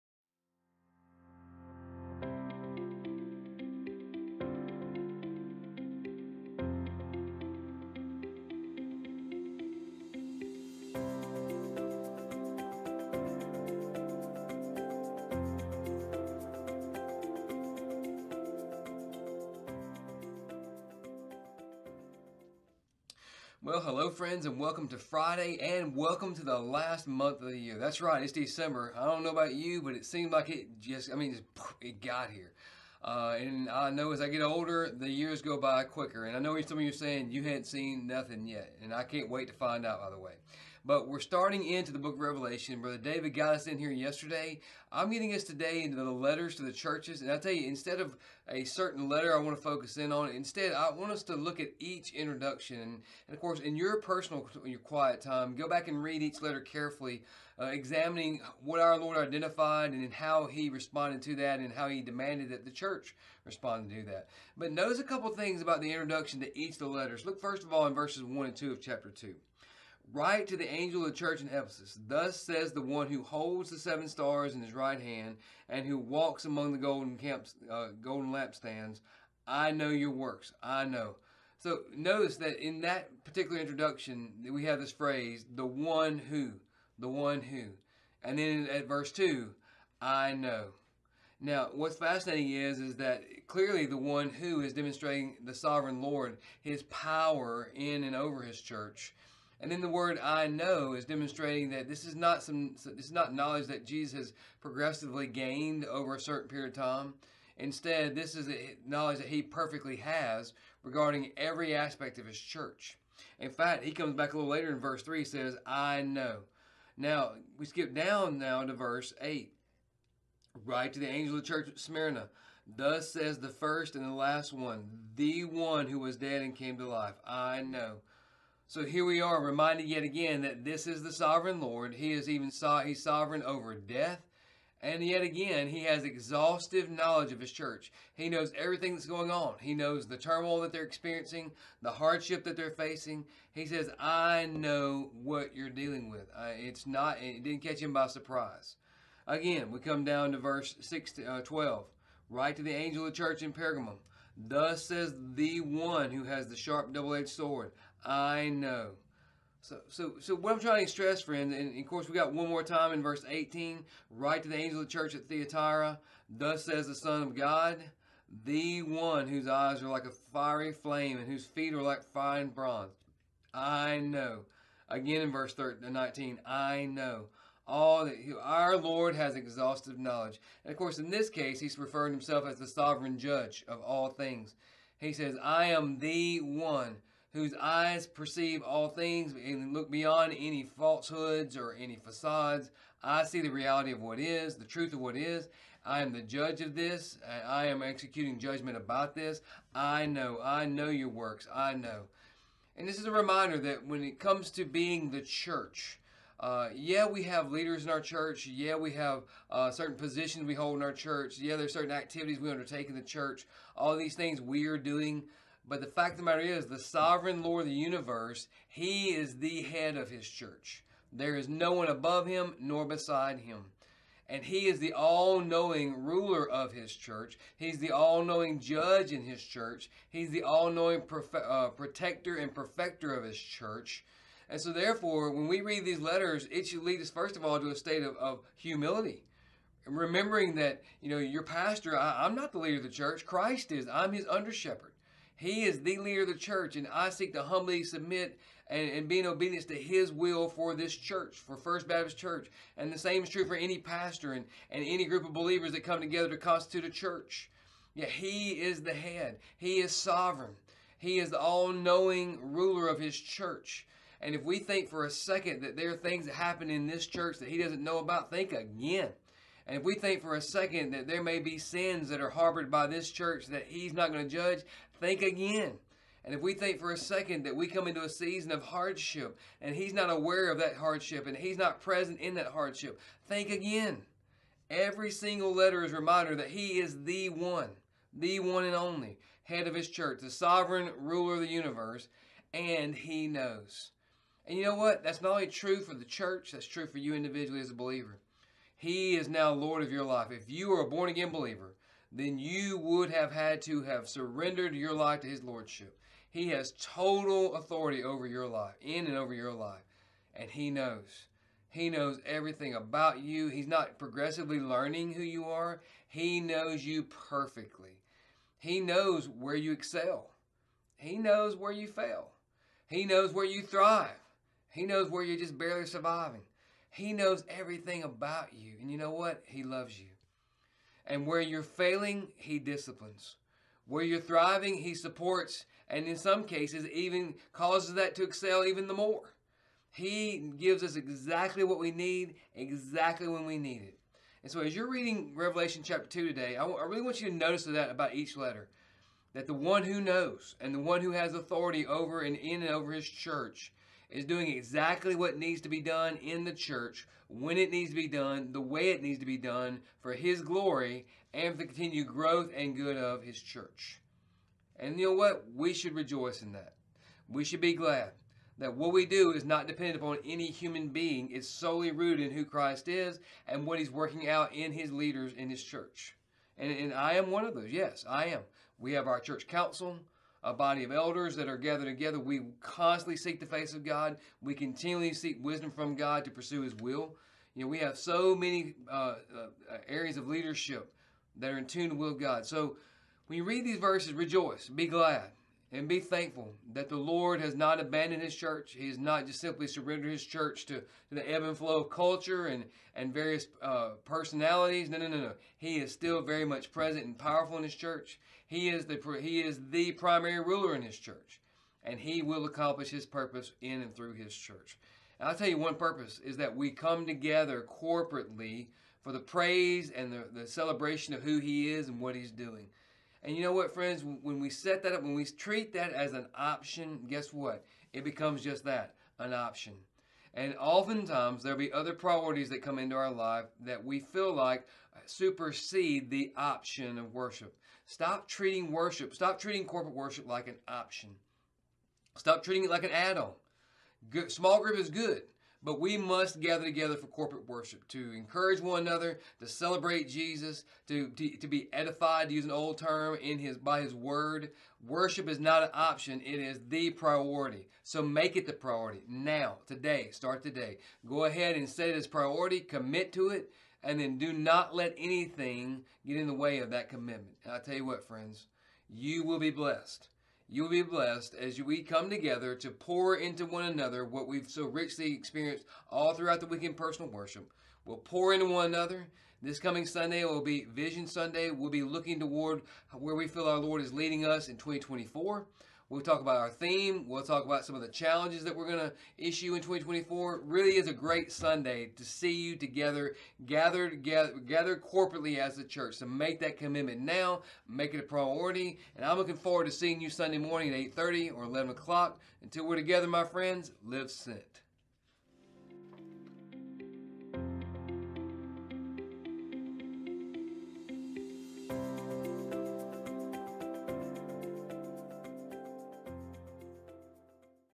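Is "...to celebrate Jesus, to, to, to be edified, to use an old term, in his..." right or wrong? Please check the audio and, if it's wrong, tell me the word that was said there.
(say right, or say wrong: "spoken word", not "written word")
right.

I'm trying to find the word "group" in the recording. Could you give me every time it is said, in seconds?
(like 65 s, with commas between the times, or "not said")
255 s, 444 s.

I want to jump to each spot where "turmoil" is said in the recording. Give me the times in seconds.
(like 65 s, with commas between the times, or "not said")
140 s.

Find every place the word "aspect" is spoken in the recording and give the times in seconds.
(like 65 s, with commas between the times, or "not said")
111 s.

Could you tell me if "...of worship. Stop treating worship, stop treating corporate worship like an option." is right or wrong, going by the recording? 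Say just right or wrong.
right.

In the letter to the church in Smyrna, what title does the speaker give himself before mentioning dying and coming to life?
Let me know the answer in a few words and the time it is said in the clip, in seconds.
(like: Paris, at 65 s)
first and the last, at 123 s.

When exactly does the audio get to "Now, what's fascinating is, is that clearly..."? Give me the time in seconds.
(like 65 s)
91 s.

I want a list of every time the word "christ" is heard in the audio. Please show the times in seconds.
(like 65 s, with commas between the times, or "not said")
243 s, 372 s.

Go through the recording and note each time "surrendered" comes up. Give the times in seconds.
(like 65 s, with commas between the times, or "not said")
304 s, 399 s.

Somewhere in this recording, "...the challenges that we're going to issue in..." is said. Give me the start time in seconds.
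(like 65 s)
487 s.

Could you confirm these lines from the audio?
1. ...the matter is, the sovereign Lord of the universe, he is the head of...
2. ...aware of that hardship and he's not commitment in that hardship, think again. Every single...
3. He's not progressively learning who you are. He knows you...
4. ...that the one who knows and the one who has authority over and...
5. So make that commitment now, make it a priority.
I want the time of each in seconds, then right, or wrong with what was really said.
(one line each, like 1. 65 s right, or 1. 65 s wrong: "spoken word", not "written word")
1. 216 s right
2. 280 s wrong: "present", not "commitment"
3. 313 s right
4. 349 s right
5. 495 s right.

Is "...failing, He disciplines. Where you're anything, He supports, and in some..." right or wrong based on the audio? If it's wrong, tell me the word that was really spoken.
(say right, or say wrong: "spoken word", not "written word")
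wrong: "thriving", not "anything".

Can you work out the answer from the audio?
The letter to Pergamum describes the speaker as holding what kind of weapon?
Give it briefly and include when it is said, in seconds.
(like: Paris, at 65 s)
sharp double edged sword, at 156 s.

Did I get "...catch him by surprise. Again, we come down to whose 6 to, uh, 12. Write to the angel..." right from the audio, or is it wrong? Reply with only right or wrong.
wrong.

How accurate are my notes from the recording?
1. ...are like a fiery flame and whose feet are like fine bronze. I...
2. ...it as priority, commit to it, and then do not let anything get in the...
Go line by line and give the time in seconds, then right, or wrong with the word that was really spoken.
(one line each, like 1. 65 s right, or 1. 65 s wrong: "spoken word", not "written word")
1. 169 s right
2. 461 s right.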